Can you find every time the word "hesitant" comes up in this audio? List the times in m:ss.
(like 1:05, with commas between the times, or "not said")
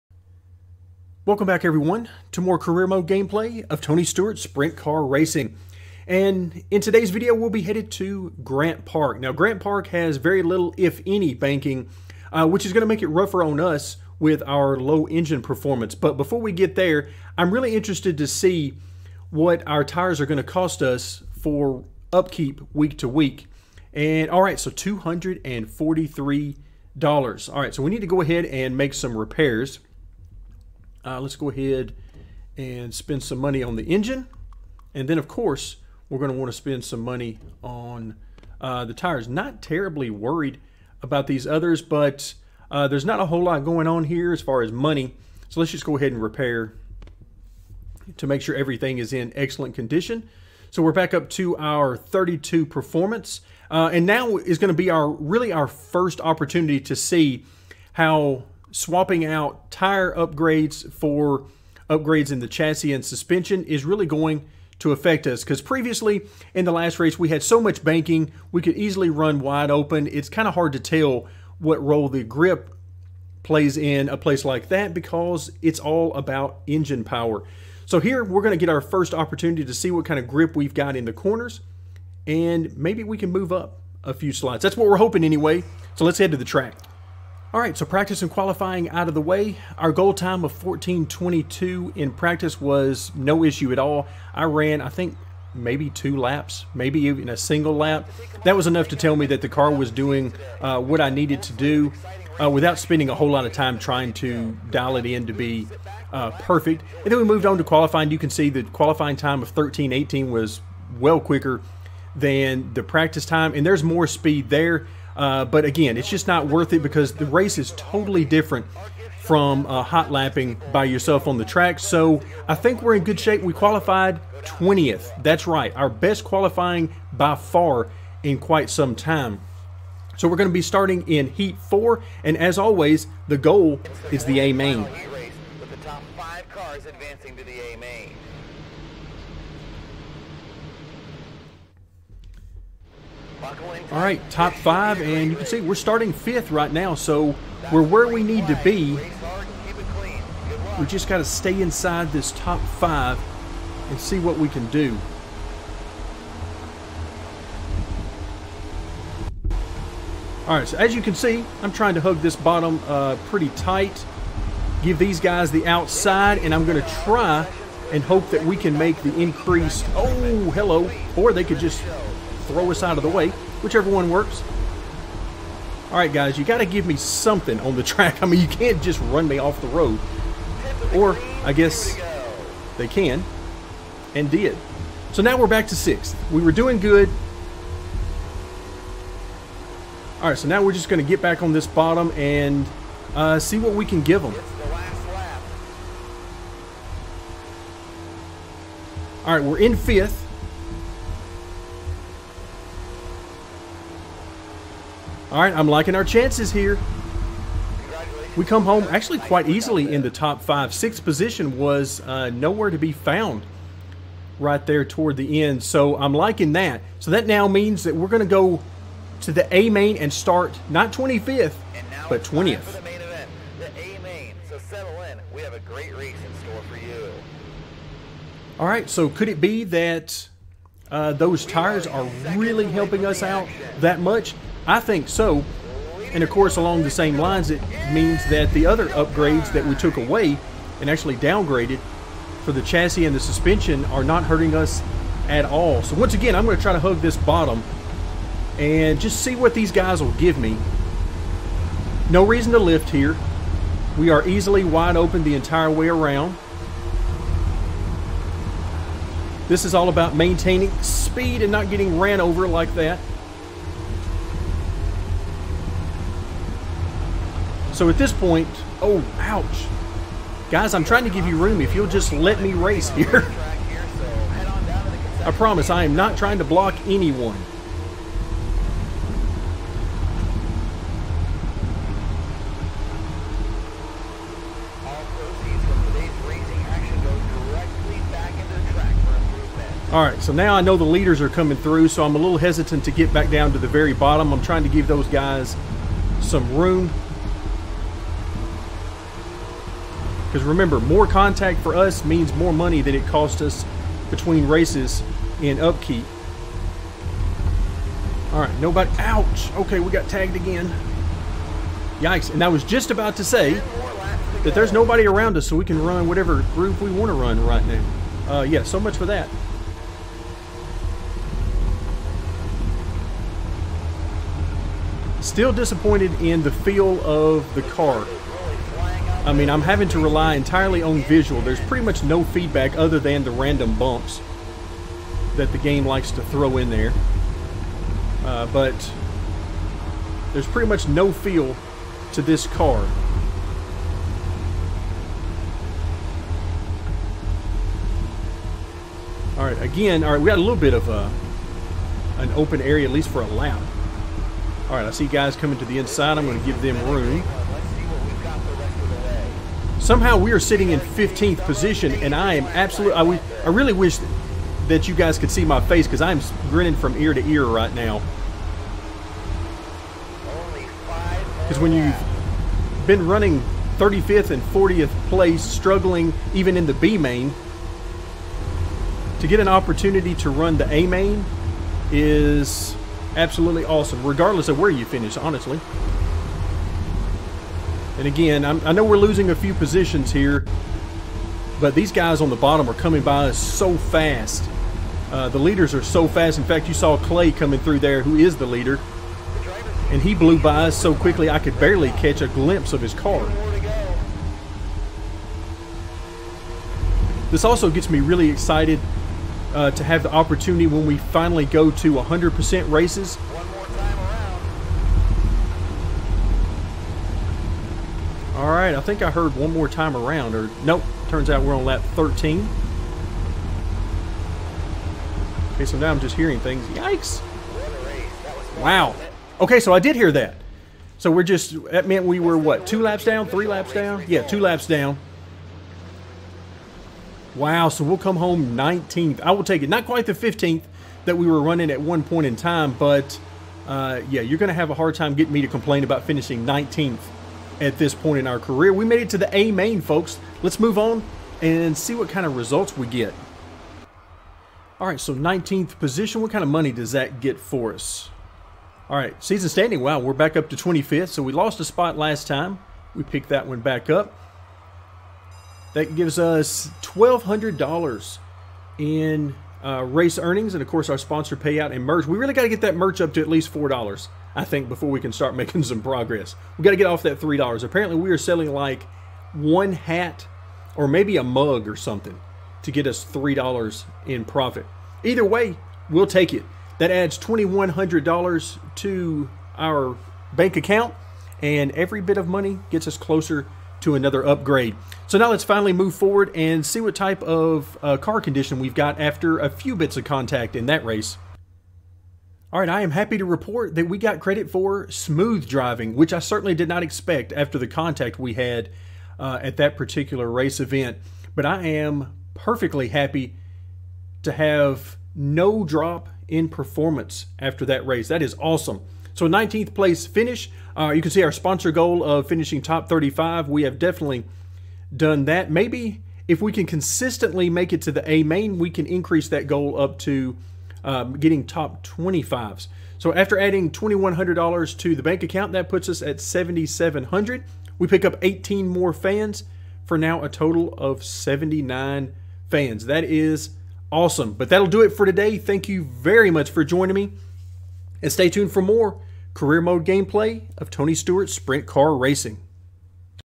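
4:52.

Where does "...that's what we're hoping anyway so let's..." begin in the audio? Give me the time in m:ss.
1:24.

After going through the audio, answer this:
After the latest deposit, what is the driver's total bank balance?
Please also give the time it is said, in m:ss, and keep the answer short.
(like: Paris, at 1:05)
7,700, at 8:56.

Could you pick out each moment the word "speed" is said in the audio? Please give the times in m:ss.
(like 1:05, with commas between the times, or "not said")
1:54, 4:20.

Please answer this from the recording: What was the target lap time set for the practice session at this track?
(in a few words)
14.22.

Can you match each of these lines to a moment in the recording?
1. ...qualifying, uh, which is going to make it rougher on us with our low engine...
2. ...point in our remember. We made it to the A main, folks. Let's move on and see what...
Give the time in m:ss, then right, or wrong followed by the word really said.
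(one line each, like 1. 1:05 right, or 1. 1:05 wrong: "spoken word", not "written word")
1. 0:11 wrong: "banking", not "qualifying"
2. 7:27 wrong: "career", not "remember".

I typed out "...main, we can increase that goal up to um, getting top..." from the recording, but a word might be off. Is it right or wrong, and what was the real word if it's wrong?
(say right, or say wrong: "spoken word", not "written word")
right.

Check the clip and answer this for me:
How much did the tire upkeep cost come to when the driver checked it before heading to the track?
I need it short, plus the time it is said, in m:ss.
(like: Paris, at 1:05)
$243, at 0:24.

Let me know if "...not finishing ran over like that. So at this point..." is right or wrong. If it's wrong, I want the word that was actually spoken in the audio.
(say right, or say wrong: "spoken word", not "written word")
wrong: "getting", not "finishing".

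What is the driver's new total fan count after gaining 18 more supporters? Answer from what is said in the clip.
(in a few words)
79.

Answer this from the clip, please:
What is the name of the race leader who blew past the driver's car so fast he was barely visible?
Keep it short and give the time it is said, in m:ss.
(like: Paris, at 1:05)
Clay, at 6:36.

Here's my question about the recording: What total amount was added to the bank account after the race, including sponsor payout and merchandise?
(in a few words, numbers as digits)
$2,100.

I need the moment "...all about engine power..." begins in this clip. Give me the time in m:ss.
1:15.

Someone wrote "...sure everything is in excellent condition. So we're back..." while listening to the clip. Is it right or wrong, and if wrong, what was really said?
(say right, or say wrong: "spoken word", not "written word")
right.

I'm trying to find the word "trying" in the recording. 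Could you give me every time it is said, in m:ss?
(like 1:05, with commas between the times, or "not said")
1:43, 2:41, 4:30, 4:36, 4:54.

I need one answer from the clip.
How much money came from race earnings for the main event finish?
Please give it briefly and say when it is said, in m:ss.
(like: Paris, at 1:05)
$1,200, at 7:46.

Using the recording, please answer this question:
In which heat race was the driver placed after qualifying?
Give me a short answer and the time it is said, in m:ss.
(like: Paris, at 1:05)
Heat 4, at 2:11.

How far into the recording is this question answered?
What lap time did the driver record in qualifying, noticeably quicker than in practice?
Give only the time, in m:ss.
1:49.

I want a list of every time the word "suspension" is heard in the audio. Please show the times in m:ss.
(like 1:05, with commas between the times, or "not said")
1:03, 4:03.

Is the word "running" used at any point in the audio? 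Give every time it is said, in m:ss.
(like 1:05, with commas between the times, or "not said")
6:13, 7:21.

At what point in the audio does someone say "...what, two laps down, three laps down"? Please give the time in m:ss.
7:12.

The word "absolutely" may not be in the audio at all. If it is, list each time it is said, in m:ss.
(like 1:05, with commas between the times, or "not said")
6:02, 6:23.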